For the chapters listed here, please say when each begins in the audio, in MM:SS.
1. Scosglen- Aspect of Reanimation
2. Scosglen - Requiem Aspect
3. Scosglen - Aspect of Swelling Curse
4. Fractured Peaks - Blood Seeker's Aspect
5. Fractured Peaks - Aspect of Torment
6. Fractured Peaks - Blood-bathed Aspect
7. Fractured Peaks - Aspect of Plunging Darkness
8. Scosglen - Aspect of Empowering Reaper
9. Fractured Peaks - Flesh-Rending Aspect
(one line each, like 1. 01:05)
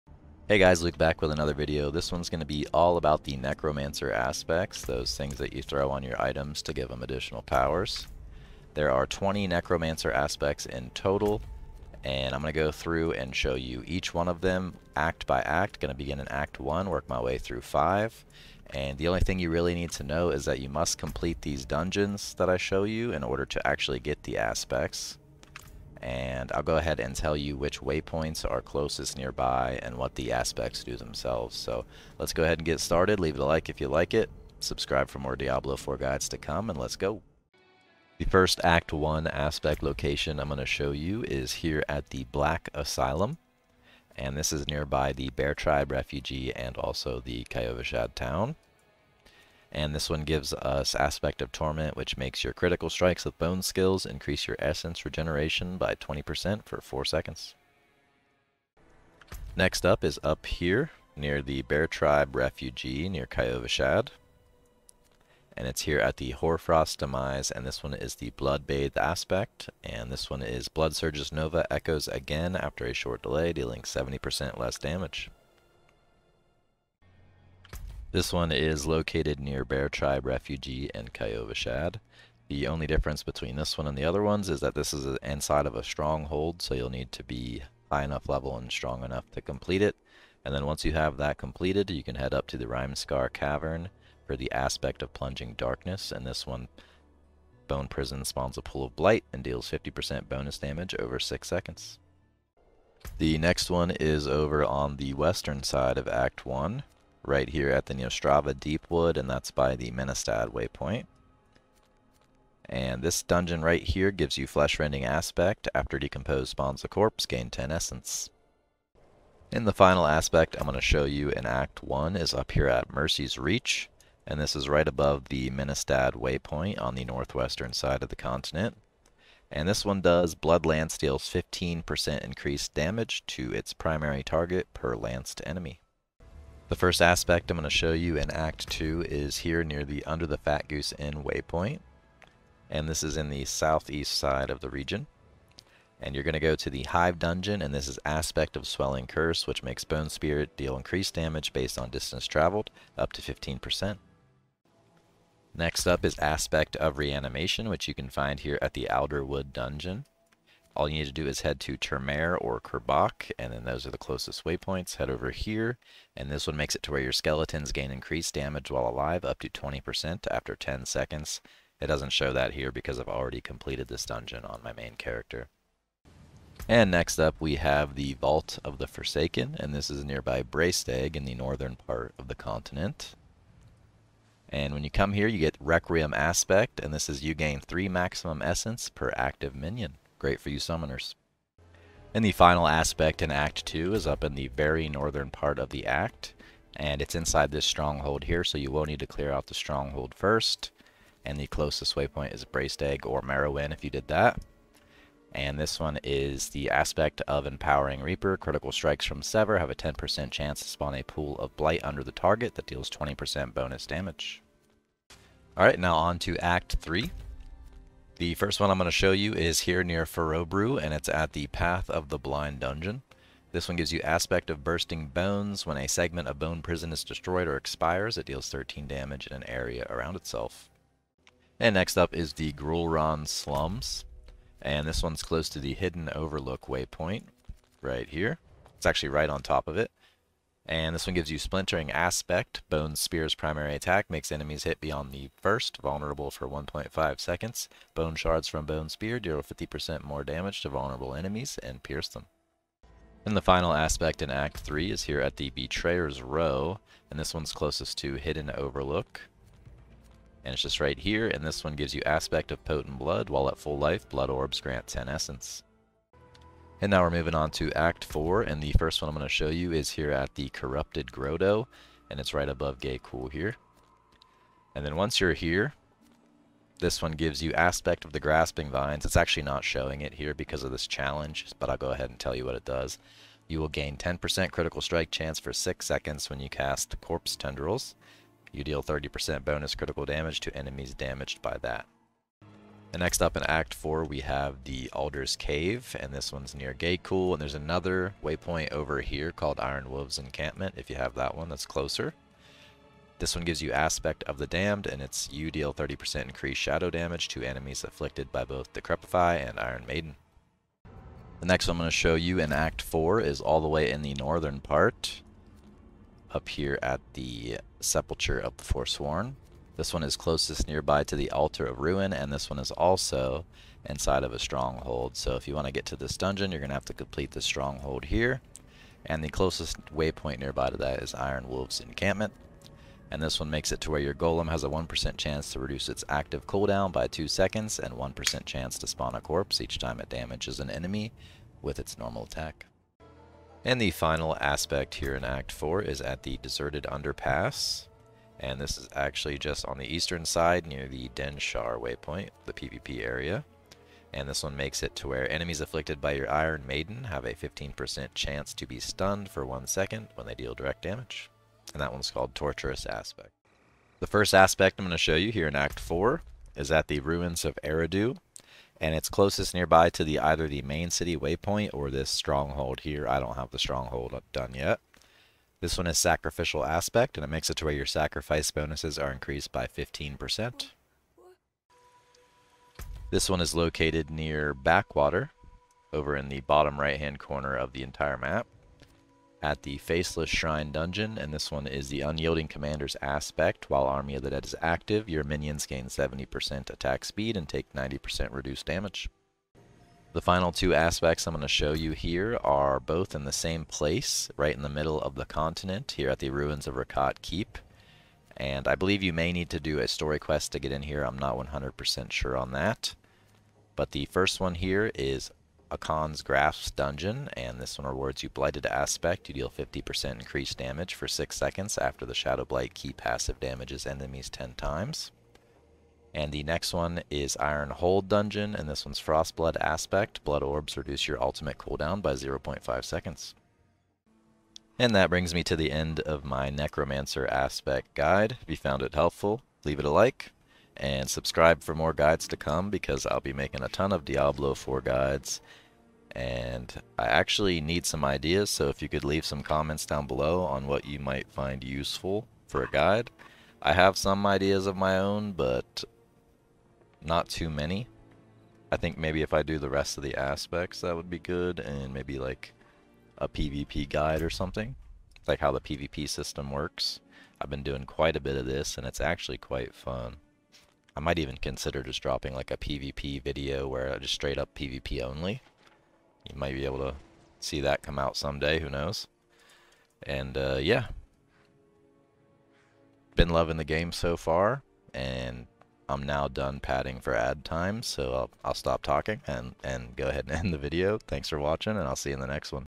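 1. 02:35
2. 02:56
3. 02:16
4. 01:58
5. 00:37
6. 00:58
7. 01:17
8. 03:11
9. 01:42.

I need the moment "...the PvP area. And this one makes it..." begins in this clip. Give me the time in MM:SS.
05:52.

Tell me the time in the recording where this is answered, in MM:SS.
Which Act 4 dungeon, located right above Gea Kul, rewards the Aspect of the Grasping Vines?
04:30.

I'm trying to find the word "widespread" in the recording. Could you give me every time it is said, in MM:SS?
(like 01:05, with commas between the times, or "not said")
not said.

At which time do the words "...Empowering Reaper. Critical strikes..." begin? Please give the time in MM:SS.
03:27.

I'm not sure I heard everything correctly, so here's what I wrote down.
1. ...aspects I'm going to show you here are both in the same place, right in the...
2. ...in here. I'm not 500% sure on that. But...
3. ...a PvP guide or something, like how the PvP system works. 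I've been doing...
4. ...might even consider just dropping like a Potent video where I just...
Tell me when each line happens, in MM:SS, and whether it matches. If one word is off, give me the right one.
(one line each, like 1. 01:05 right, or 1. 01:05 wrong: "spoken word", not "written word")
1. 06:40 right
2. 06:50 wrong: "100", not "500"
3. 07:43 right
4. 07:50 wrong: "PvP", not "Potent".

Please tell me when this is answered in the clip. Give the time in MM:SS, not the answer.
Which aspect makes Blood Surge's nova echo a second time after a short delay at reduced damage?
01:08.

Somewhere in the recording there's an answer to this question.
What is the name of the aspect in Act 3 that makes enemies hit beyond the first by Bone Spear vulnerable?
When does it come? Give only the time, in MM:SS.
04:01.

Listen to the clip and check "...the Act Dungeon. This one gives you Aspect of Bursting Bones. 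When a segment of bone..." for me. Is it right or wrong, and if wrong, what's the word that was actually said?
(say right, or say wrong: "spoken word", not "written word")
wrong: "Blind", not "Act".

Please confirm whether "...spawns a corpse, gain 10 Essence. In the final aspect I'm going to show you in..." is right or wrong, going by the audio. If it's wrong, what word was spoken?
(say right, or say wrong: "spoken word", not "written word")
right.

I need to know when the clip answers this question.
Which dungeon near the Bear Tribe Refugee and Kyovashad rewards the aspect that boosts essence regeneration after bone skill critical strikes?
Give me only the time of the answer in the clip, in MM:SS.
00:42.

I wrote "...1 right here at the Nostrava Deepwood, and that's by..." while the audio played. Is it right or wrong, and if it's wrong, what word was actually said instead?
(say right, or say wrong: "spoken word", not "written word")
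right.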